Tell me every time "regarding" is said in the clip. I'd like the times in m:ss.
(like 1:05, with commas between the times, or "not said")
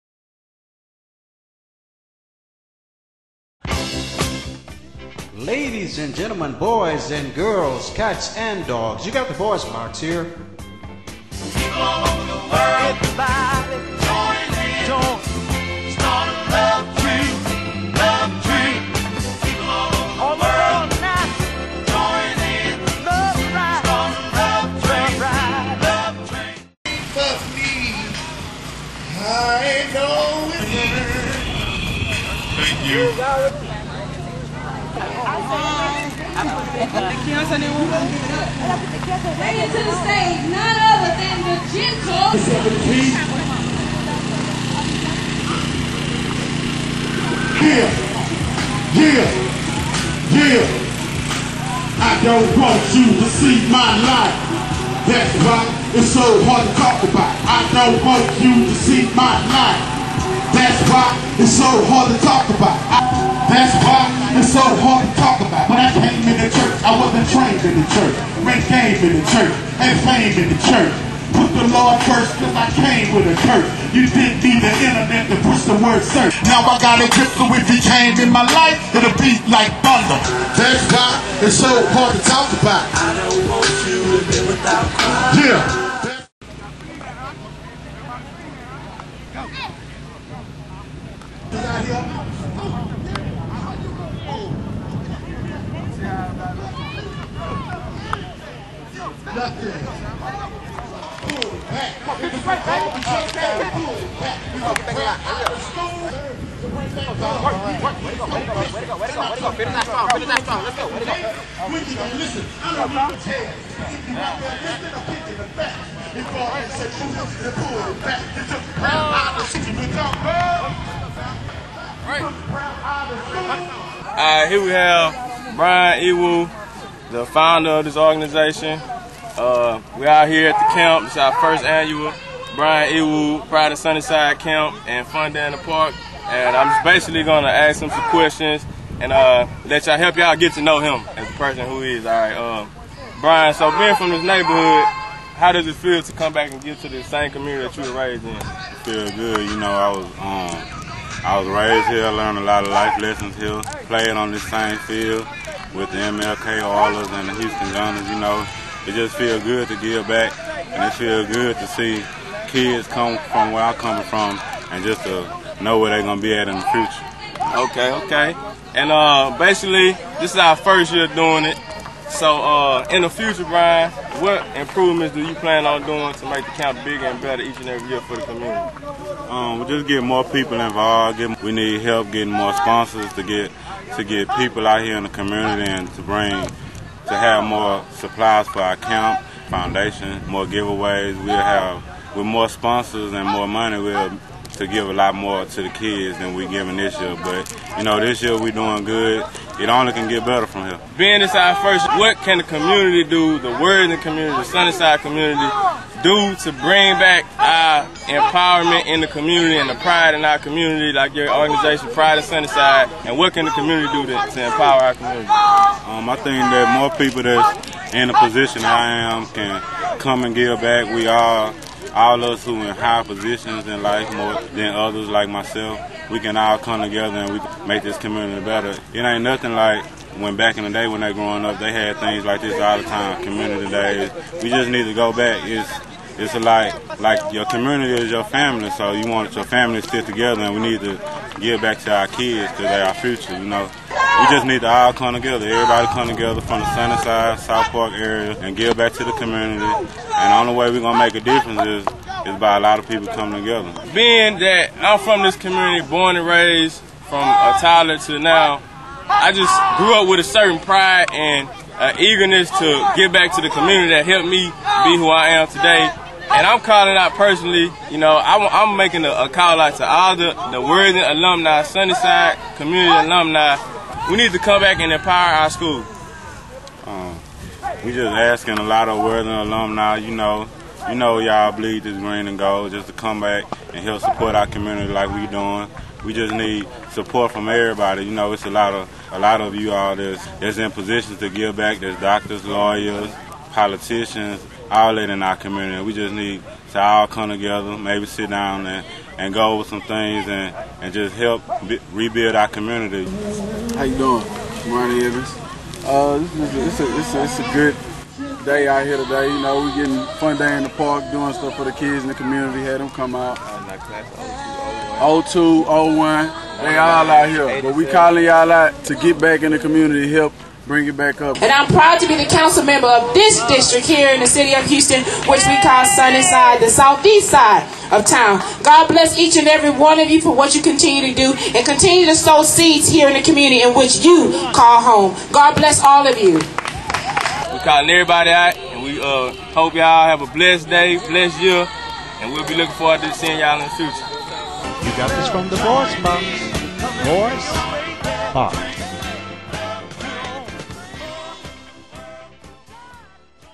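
not said.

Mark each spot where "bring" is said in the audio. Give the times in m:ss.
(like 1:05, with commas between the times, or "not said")
0:34, 3:06, 3:26, 5:20.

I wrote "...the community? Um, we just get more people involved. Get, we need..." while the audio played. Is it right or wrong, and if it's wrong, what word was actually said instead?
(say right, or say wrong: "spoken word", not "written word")
right.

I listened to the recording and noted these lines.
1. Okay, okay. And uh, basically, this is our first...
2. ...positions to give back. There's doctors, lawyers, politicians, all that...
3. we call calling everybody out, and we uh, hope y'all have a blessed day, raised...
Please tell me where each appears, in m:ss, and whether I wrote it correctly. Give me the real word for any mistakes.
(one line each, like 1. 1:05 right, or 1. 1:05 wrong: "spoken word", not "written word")
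1. 2:47 right
2. 4:50 right
3. 5:36 wrong: "blessed", not "raised".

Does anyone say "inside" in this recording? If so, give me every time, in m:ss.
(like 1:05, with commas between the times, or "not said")
3:21.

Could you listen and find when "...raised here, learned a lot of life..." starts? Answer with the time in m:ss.
2:31.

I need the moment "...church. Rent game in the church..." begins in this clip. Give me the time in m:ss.
1:07.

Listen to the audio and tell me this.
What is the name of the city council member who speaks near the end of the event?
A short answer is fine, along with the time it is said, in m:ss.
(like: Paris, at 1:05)
Ronnie Evans, at 5:04.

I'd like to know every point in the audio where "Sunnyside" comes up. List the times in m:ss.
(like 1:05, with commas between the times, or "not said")
2:13, 3:24, 3:32, 4:06, 4:31, 5:25.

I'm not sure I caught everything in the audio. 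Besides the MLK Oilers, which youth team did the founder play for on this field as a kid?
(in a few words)
Houston Gunners.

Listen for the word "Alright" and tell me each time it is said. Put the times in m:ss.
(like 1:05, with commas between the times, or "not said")
1:56.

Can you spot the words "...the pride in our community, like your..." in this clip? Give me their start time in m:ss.
3:29.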